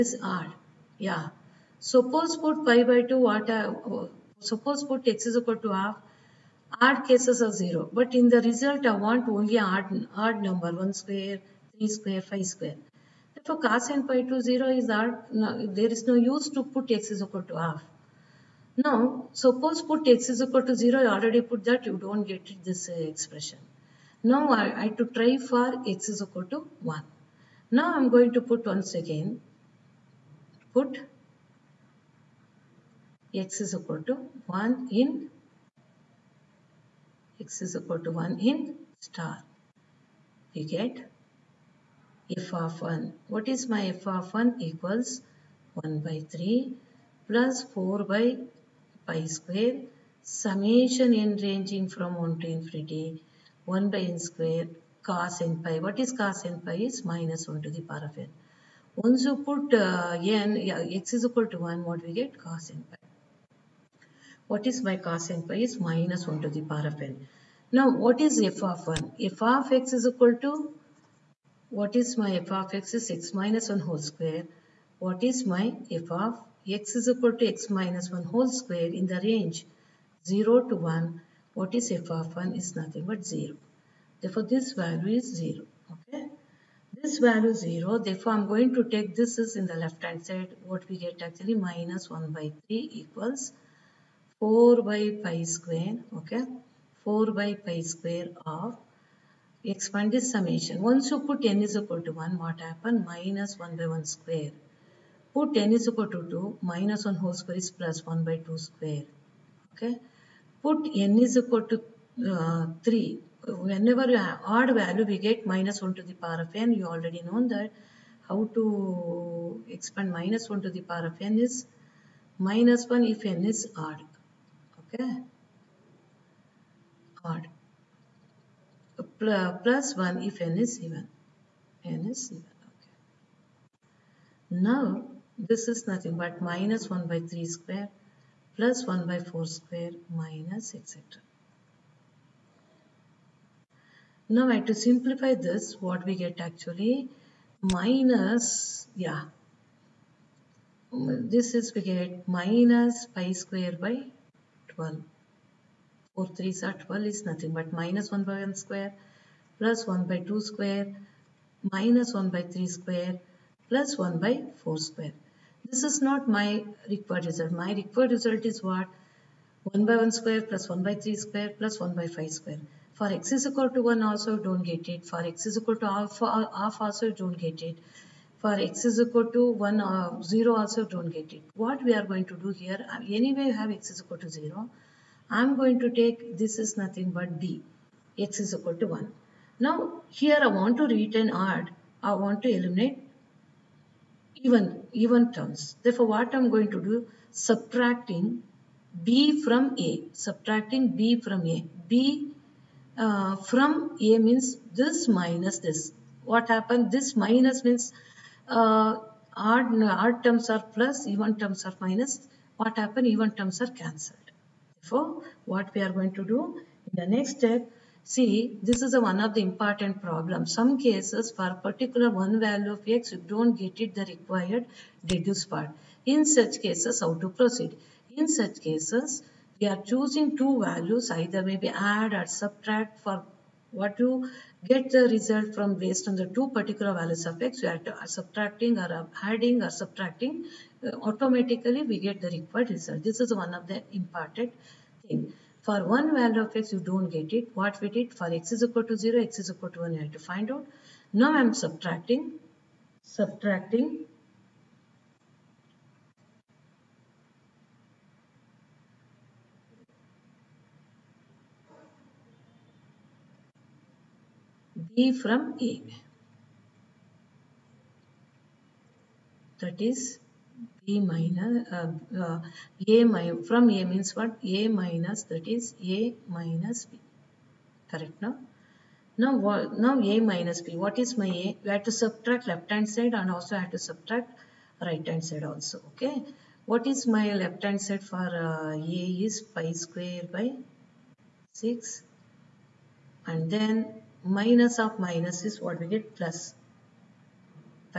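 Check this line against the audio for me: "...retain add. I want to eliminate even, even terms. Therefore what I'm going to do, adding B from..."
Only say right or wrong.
wrong.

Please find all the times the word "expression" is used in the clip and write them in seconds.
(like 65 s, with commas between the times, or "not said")
22 s.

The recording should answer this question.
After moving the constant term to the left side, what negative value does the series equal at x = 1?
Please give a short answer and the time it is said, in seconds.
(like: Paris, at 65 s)
-pi^2/12, at 152 s.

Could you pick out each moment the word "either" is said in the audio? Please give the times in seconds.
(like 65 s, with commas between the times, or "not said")
231 s.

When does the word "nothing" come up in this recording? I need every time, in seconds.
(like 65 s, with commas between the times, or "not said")
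82 s, 135 s, 157 s, 186 s.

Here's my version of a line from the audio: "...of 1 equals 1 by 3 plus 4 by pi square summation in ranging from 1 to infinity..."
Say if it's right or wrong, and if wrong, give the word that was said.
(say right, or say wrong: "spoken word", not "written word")
right.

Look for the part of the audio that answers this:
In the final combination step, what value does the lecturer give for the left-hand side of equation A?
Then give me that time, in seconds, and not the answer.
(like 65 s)
289 s.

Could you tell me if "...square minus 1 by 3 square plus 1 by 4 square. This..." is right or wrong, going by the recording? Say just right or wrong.
right.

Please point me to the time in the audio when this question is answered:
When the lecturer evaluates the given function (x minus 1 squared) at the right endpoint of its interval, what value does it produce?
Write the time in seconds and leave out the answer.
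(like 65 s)
81 s.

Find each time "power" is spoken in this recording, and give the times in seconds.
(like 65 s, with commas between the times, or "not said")
57 s, 66 s, 116 s, 120 s.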